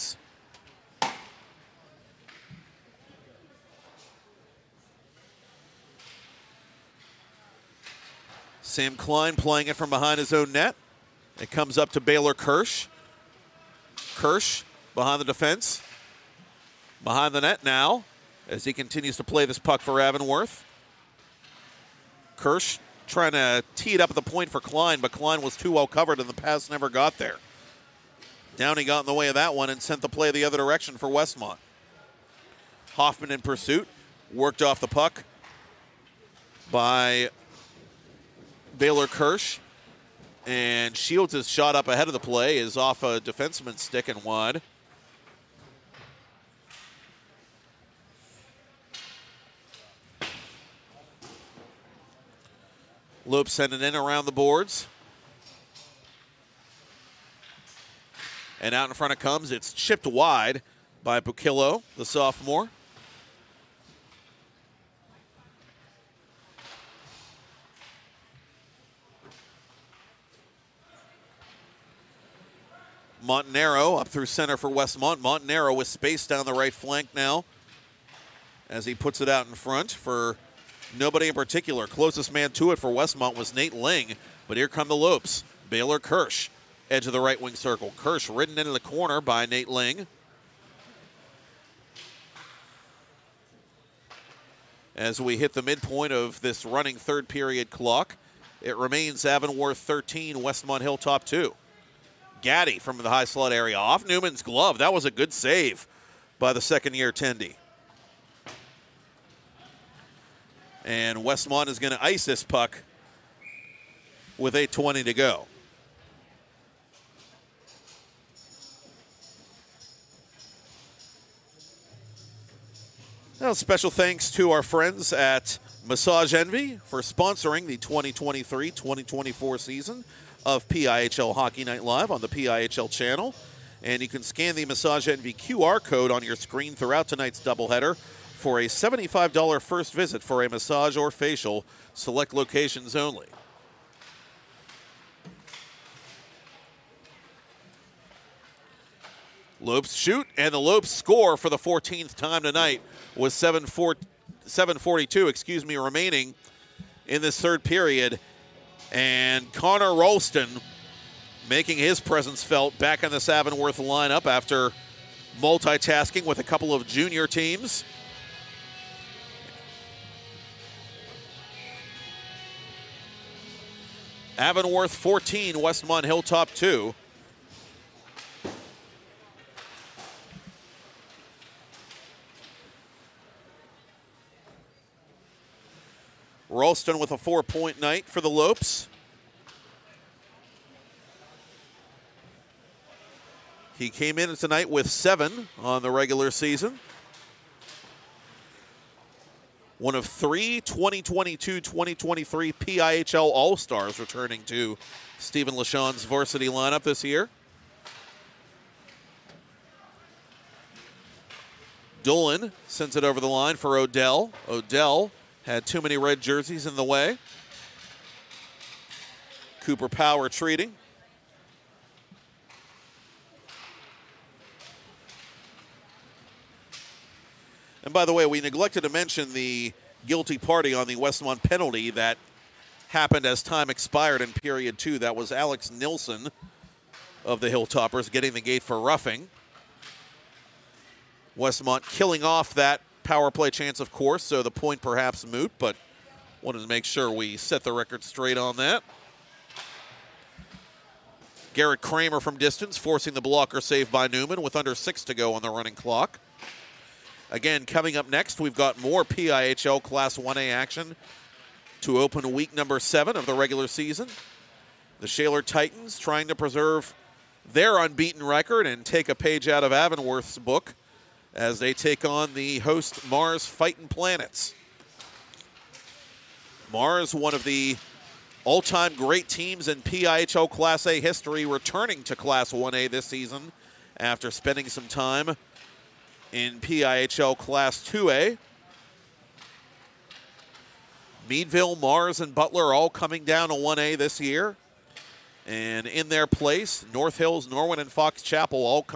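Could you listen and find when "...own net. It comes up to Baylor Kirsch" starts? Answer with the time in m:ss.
0:10.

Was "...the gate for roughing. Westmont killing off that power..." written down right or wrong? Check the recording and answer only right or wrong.
right.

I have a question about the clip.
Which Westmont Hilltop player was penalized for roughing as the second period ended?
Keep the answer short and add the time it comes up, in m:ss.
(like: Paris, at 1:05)
Alex Nilson, at 3:55.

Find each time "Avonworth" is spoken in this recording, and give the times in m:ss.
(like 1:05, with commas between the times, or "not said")
0:19, 1:39, 2:54, 4:29.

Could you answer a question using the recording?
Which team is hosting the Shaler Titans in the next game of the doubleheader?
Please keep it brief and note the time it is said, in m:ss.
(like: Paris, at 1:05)
Mars Fighting Planets, at 4:33.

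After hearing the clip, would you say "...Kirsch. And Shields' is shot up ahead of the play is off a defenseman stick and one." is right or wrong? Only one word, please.
right.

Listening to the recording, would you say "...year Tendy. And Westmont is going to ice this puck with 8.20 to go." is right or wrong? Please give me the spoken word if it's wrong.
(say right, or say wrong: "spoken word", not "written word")
right.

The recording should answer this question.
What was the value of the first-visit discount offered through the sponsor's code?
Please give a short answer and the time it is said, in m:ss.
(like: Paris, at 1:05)
$75, at 2:18.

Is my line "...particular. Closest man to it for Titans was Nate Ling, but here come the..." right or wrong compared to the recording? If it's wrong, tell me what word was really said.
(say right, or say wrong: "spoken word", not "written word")
wrong: "Westmont", not "Titans".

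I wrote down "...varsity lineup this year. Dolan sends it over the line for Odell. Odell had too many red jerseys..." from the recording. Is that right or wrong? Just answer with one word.
right.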